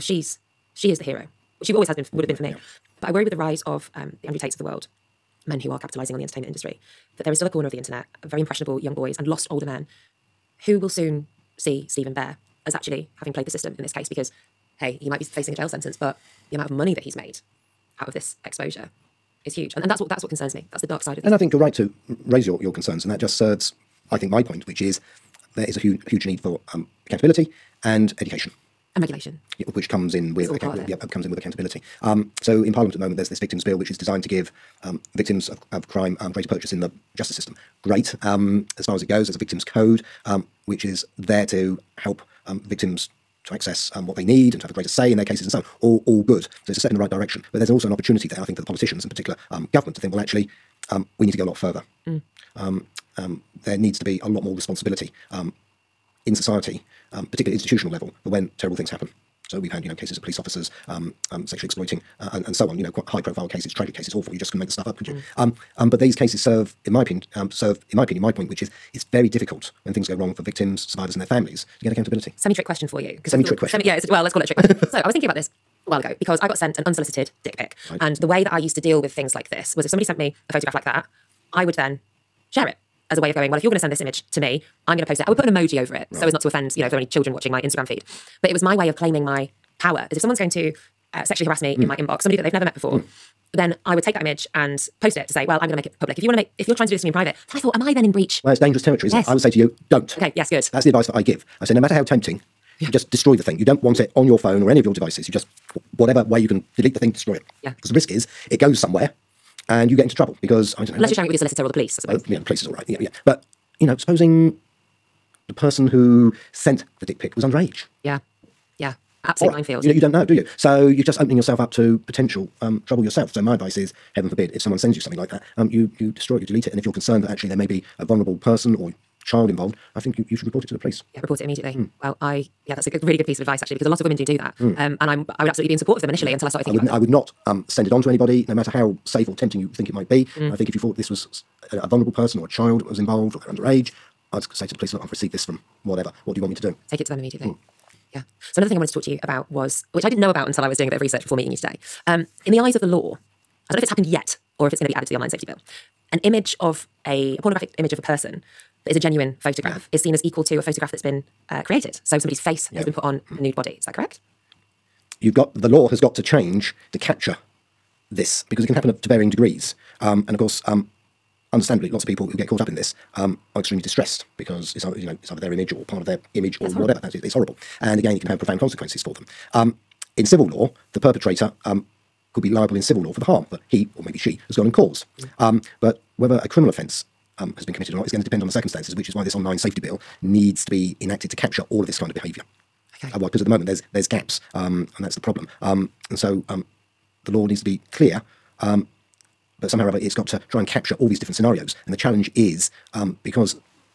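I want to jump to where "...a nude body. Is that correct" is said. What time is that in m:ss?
2:43.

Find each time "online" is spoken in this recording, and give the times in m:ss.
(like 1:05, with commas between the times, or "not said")
2:35, 3:09.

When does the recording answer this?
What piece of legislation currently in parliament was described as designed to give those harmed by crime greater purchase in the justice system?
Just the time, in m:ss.
0:33.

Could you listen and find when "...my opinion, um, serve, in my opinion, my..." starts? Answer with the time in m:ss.
1:06.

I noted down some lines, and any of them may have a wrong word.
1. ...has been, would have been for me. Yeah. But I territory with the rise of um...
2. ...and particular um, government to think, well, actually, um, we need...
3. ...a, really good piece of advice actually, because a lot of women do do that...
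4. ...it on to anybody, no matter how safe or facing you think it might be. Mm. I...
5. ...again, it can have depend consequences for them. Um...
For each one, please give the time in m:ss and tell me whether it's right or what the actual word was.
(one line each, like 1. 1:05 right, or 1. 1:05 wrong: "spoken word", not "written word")
1. 0:01 wrong: "worry", not "territory"
2. 0:49 right
3. 2:12 right
4. 2:17 wrong: "tempting", not "facing"
5. 2:57 wrong: "profound", not "depend".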